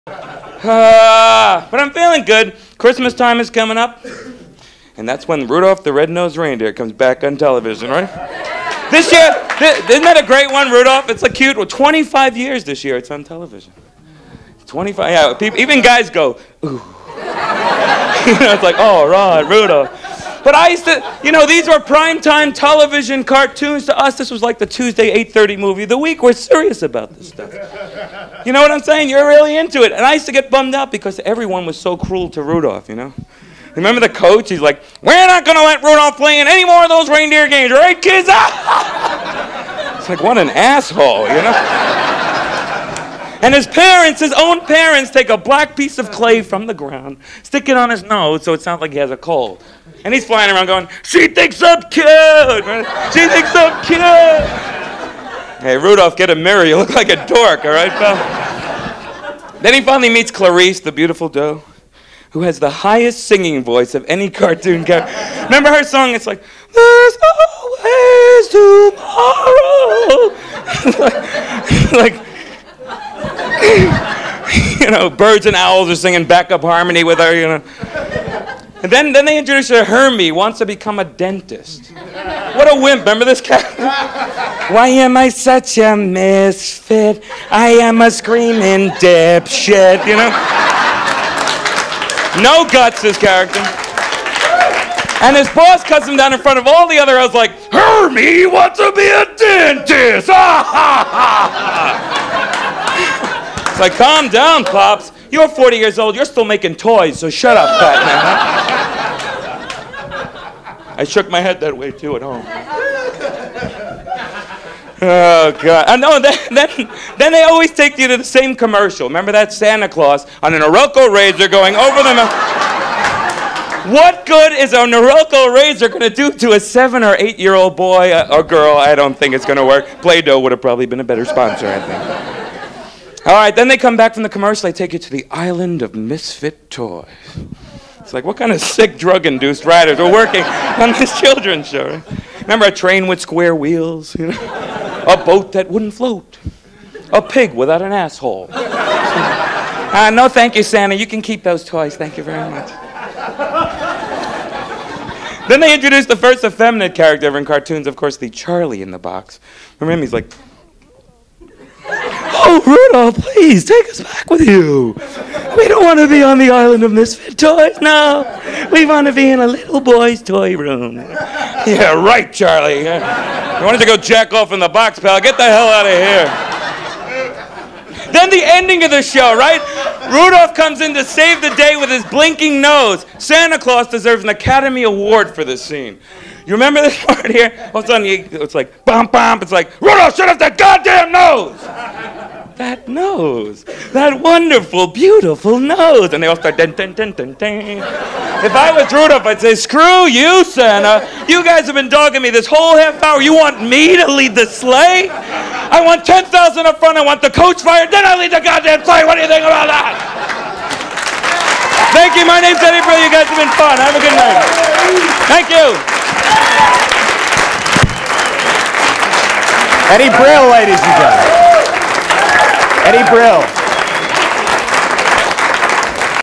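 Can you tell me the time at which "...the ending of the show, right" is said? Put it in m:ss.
2:58.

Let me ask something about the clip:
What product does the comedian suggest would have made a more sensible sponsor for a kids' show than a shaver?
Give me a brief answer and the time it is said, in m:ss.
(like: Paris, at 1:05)
Play-Doh, at 2:10.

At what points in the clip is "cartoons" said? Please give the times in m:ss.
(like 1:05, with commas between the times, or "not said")
0:23, 1:04, 2:37.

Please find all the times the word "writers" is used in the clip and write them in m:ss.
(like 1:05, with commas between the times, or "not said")
2:19.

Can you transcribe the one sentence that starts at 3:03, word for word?
Santa Claus deserves an Academy Award for this scene.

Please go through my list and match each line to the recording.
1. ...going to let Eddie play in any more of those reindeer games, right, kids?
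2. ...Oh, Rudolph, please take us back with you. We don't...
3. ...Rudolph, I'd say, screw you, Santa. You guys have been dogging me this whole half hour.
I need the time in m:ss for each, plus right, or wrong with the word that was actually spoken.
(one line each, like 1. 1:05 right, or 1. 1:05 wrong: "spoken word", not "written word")
1. 0:35 wrong: "Rudolph", not "Eddie"
2. 2:42 right
3. 3:18 right.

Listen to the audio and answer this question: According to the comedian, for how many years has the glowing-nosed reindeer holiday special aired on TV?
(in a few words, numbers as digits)
25.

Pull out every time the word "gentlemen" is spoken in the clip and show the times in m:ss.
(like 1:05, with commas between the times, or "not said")
3:40.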